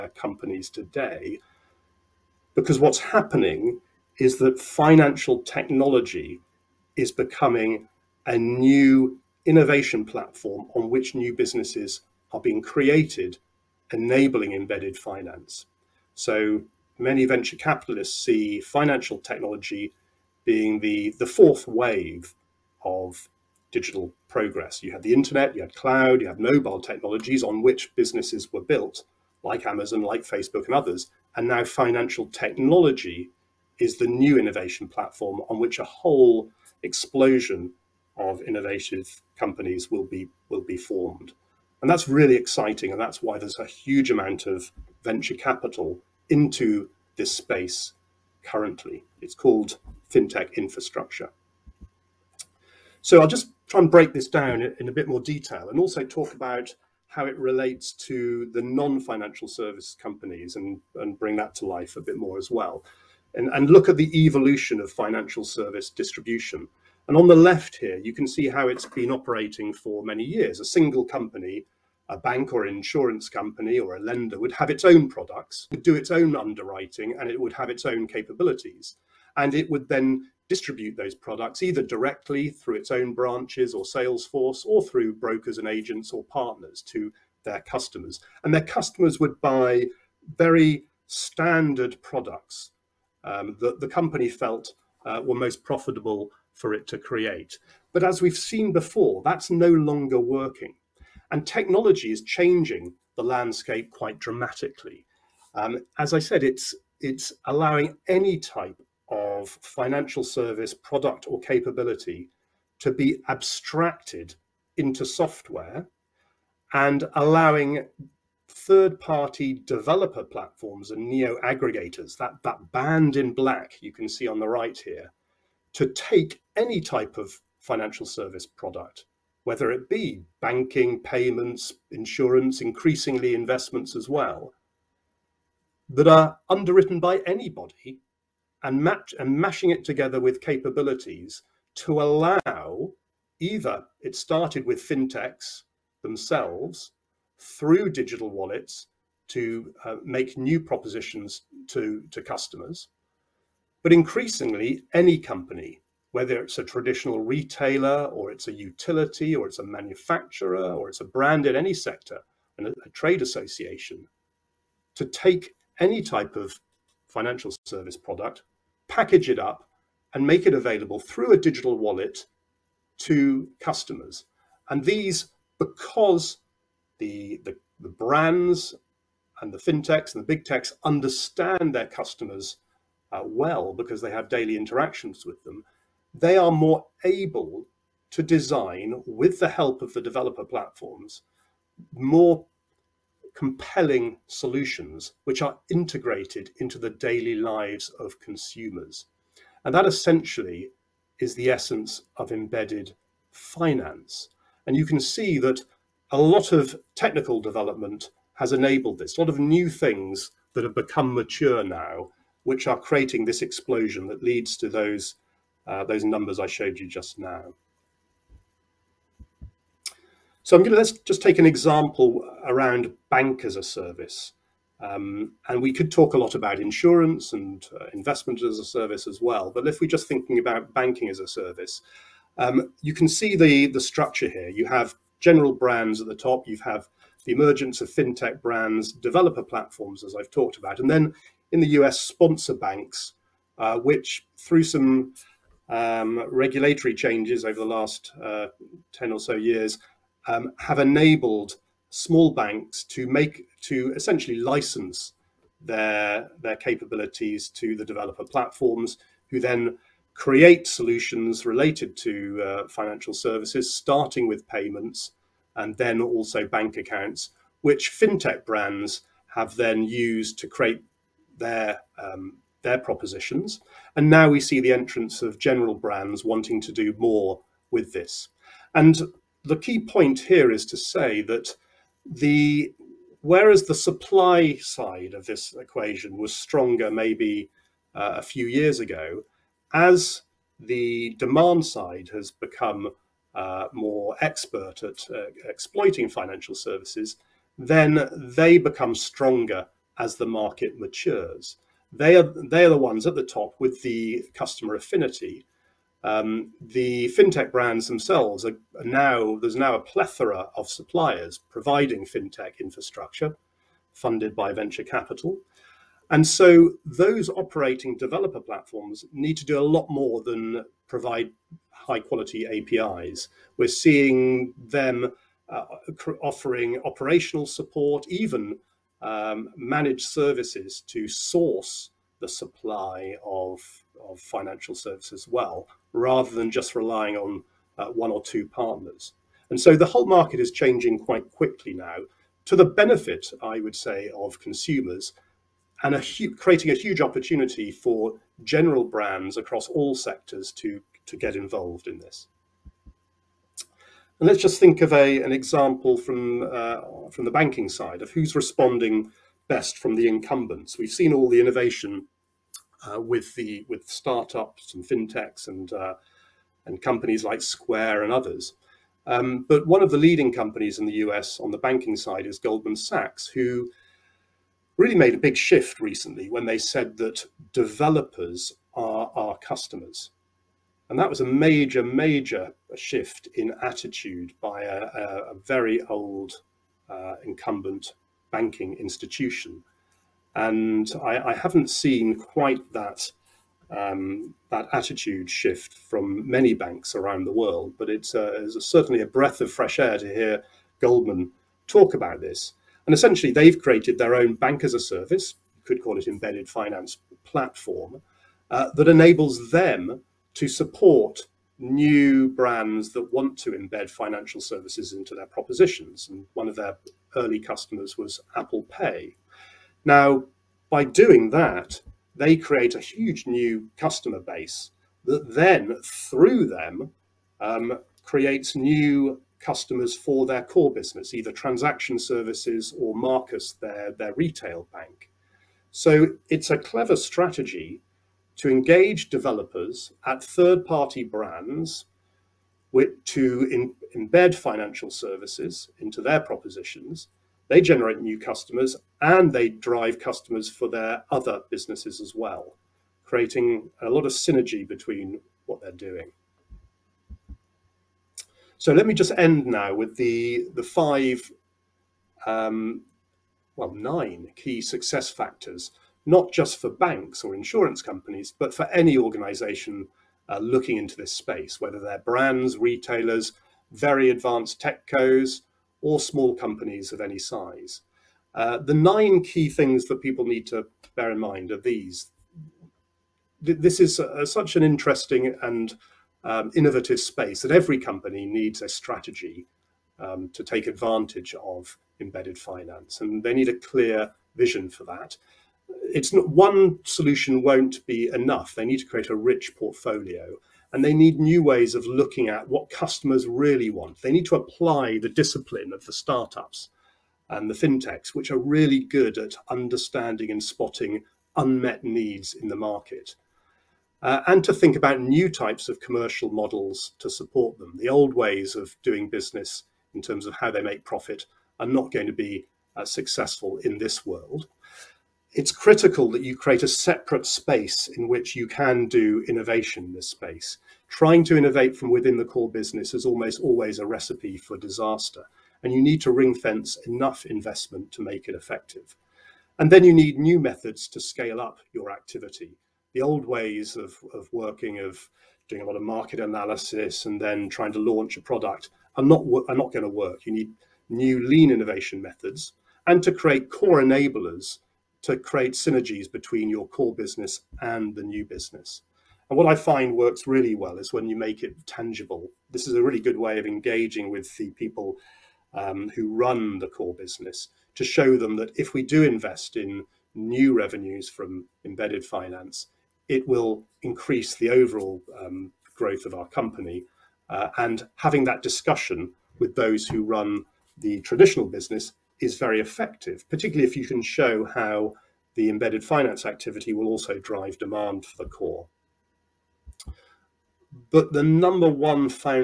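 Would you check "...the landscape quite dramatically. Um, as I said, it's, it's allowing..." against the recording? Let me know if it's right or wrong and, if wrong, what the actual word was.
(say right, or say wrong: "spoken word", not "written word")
right.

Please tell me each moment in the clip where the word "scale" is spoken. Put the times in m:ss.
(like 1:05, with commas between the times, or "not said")
9:01.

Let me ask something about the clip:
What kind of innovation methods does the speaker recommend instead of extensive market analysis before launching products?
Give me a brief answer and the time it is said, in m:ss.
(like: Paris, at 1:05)
lean innovation methods, at 9:11.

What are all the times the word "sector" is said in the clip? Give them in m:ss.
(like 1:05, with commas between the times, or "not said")
2:41, 5:49.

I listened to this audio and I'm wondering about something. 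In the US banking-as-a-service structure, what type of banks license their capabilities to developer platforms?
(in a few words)
sponsor banks.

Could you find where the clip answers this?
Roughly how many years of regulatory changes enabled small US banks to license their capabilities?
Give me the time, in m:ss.
4:08.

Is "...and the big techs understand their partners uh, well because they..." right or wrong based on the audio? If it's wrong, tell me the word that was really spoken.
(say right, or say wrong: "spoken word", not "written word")
wrong: "customers", not "partners".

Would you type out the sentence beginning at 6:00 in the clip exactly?
We've seen all the innovation uh, with, the, with startups and fintechs and, uh, and companies like Square and others.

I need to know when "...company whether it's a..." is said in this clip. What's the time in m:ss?
2:35.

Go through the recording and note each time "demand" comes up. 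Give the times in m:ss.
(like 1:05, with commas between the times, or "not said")
4:51, 9:47.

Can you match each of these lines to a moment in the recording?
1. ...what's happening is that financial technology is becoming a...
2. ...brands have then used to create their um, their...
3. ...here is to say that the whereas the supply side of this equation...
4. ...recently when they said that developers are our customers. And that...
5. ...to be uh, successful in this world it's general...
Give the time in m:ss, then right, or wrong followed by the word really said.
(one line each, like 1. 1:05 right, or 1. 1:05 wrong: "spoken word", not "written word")
1. 0:02 right
2. 4:28 right
3. 4:40 right
4. 6:15 right
5. 8:42 wrong: "critical", not "general".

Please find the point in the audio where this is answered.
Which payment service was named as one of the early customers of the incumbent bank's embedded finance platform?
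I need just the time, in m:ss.
6:58.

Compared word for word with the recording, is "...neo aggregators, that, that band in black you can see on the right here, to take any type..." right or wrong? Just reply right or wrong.
right.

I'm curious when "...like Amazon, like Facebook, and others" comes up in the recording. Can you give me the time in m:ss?
0:29.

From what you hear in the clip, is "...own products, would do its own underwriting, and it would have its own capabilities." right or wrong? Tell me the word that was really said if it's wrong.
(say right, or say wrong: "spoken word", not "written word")
right.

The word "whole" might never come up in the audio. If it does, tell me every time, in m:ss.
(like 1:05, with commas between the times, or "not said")
0:35, 5:39.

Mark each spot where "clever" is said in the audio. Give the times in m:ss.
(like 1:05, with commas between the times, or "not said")
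7:16.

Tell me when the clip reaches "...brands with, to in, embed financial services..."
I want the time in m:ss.
7:21.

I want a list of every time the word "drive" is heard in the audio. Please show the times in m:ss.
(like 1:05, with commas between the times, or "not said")
7:29, 9:47.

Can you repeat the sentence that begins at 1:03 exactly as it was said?
And, and look at the evolution of financial service distribution.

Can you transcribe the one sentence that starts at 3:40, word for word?
So I'm going to let's just take an example around bank as a service.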